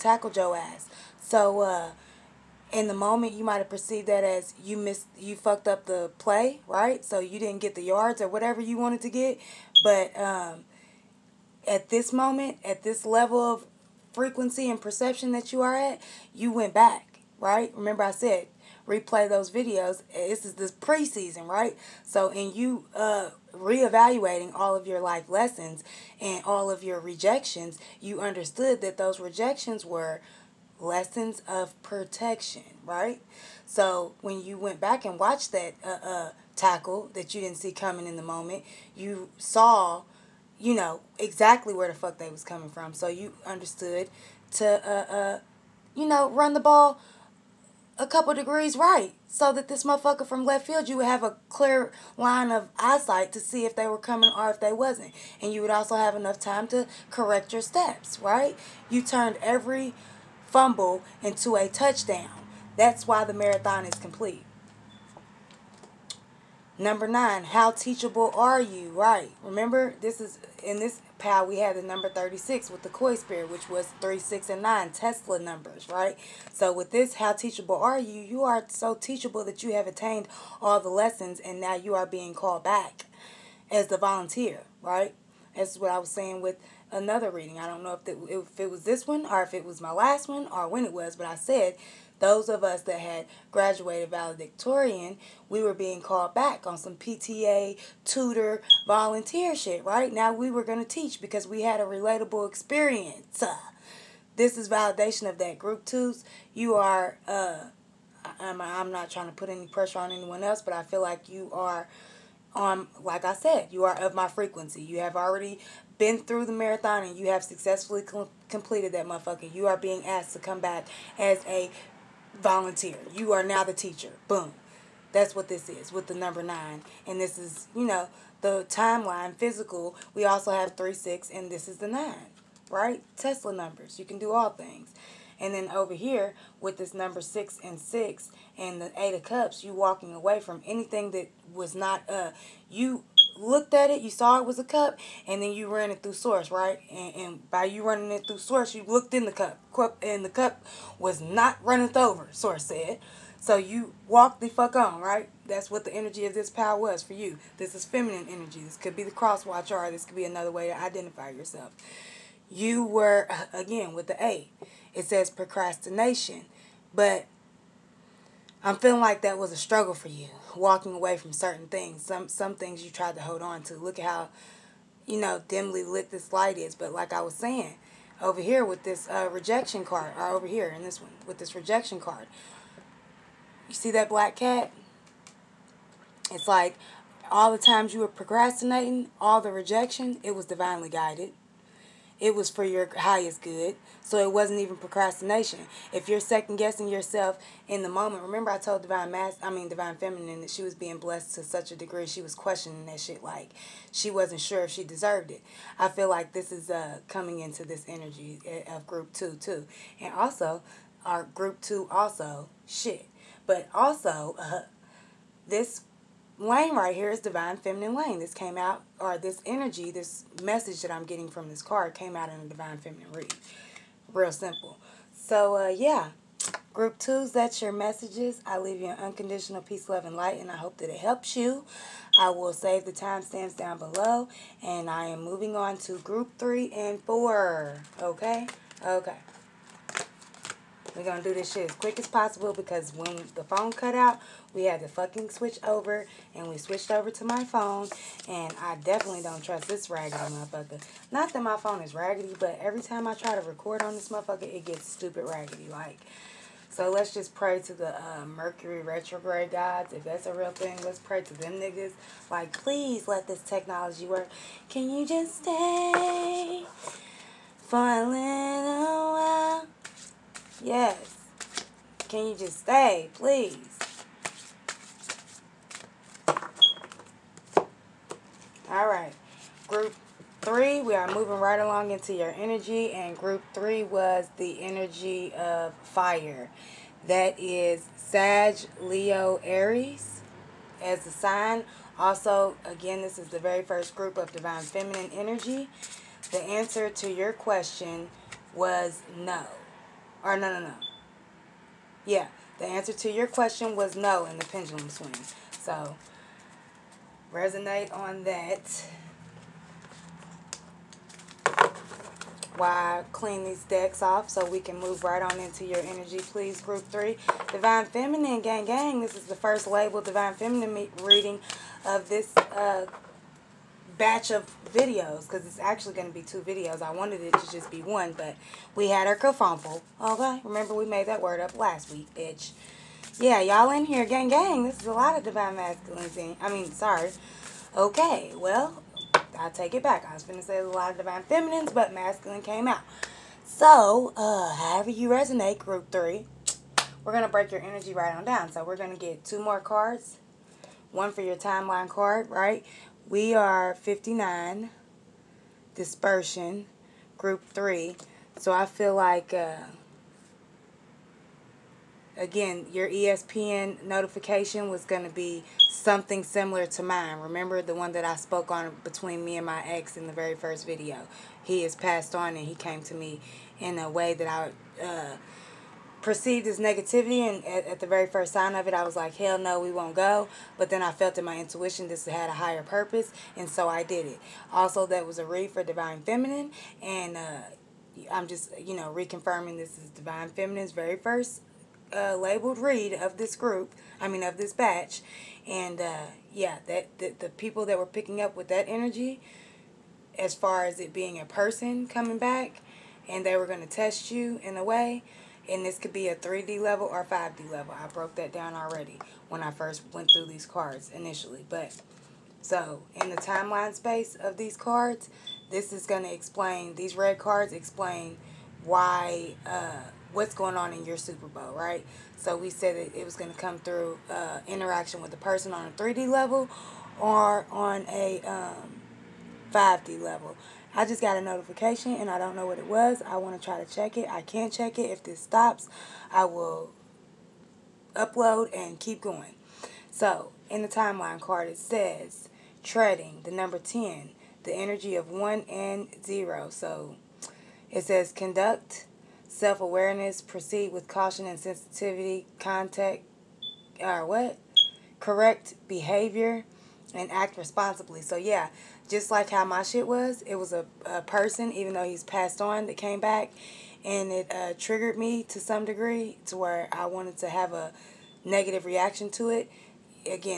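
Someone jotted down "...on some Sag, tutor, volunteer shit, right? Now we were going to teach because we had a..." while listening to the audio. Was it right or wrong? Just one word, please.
wrong.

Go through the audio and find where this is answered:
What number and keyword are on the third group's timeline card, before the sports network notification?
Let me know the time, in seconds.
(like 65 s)
353 s.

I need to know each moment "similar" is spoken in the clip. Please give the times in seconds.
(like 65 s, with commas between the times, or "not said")
366 s.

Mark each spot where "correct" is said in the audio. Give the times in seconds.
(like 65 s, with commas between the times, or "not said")
57 s, 454 s.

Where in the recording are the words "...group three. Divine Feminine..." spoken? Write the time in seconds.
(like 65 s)
316 s.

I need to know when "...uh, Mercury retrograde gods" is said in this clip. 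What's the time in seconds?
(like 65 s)
257 s.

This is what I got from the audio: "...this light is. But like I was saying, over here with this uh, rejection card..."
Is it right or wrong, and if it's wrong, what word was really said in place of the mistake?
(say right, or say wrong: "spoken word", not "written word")
right.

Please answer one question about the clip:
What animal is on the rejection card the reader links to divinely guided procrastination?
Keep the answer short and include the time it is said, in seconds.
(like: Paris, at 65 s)
Black cat, at 184 s.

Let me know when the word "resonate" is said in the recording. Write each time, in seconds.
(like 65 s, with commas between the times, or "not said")
307 s, 345 s.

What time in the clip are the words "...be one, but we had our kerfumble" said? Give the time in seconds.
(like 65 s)
327 s.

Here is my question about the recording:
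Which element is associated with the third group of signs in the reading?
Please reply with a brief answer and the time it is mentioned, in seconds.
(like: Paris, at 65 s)
Fire, at 285 s.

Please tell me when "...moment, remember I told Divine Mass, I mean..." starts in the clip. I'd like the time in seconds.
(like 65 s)
197 s.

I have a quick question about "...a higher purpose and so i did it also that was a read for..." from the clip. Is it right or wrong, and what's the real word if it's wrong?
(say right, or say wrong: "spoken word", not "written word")
right.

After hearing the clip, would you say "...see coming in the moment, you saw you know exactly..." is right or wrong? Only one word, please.
right.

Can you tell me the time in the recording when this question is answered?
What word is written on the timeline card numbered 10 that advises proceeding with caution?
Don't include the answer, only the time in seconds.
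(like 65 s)
442 s.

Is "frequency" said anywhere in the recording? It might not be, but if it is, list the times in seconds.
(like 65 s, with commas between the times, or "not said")
14 s, 114 s.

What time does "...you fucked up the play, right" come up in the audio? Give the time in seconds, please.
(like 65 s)
5 s.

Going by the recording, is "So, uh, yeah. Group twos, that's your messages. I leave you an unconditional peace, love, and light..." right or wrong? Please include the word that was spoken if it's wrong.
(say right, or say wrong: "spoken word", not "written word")
right.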